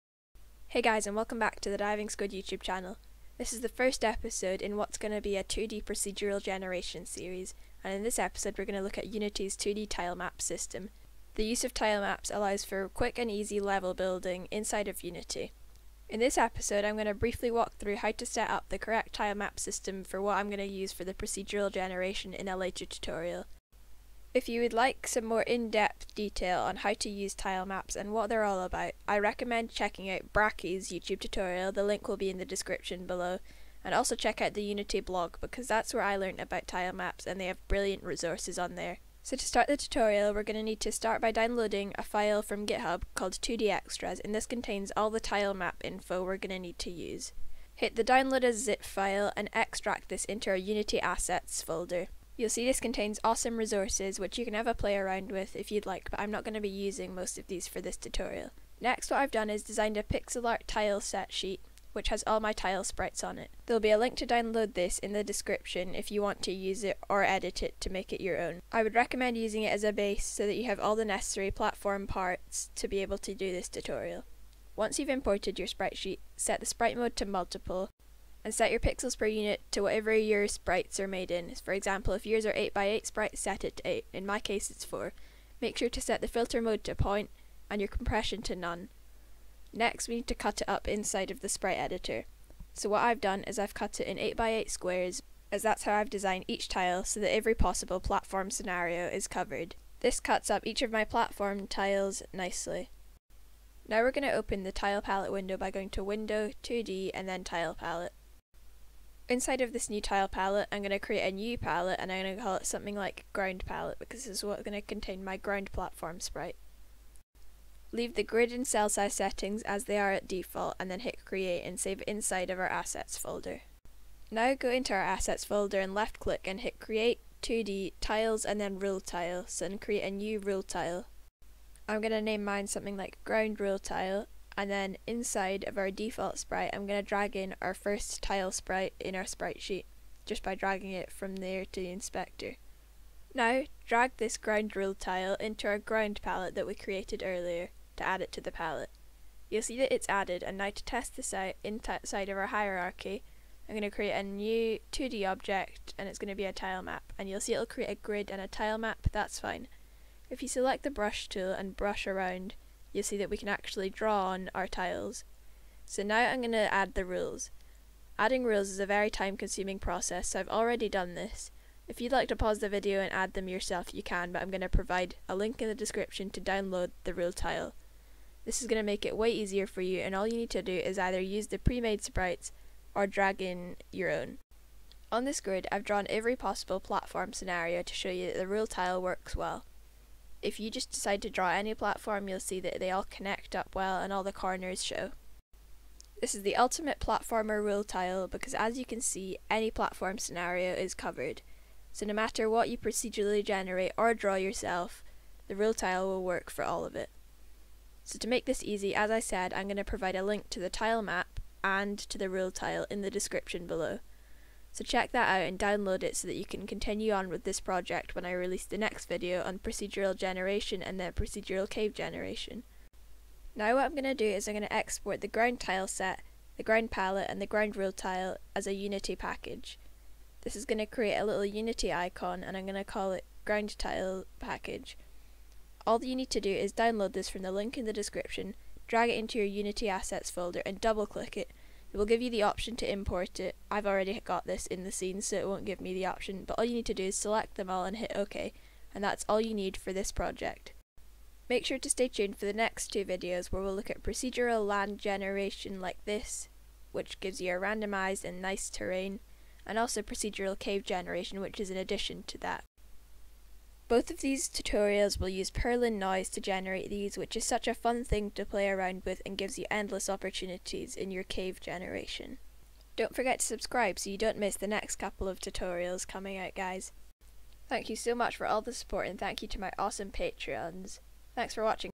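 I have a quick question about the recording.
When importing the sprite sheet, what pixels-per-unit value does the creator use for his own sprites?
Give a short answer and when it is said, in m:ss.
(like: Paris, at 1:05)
4, at 1:24.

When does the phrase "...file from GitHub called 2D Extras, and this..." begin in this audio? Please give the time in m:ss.
0:42.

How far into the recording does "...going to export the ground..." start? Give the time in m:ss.
3:44.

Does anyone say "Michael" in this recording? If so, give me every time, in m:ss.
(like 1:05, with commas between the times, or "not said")
not said.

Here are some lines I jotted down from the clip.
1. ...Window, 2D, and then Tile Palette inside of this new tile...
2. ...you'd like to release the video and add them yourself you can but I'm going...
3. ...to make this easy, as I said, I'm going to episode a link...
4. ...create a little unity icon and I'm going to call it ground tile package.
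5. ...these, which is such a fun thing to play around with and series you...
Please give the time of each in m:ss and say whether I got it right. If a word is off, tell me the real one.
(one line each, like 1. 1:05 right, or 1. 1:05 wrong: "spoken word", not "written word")
1. 1:46 right
2. 2:51 wrong: "pause", not "release"
3. 3:28 wrong: "provide", not "episode"
4. 3:50 right
5. 4:26 wrong: "gives", not "series".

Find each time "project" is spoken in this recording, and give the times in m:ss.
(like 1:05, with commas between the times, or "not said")
3:37, 4:10.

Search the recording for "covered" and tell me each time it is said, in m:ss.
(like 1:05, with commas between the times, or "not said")
1:39, 3:20.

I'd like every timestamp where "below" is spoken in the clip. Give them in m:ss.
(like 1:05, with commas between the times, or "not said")
0:33, 3:33.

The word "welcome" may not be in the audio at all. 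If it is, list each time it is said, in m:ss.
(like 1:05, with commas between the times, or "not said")
0:01.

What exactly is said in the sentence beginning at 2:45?
So now I'm going to add the rules.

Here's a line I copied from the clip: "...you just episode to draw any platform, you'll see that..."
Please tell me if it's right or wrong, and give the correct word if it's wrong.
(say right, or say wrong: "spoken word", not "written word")
wrong: "decide", not "episode".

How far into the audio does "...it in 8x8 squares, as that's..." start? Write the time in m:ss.
1:33.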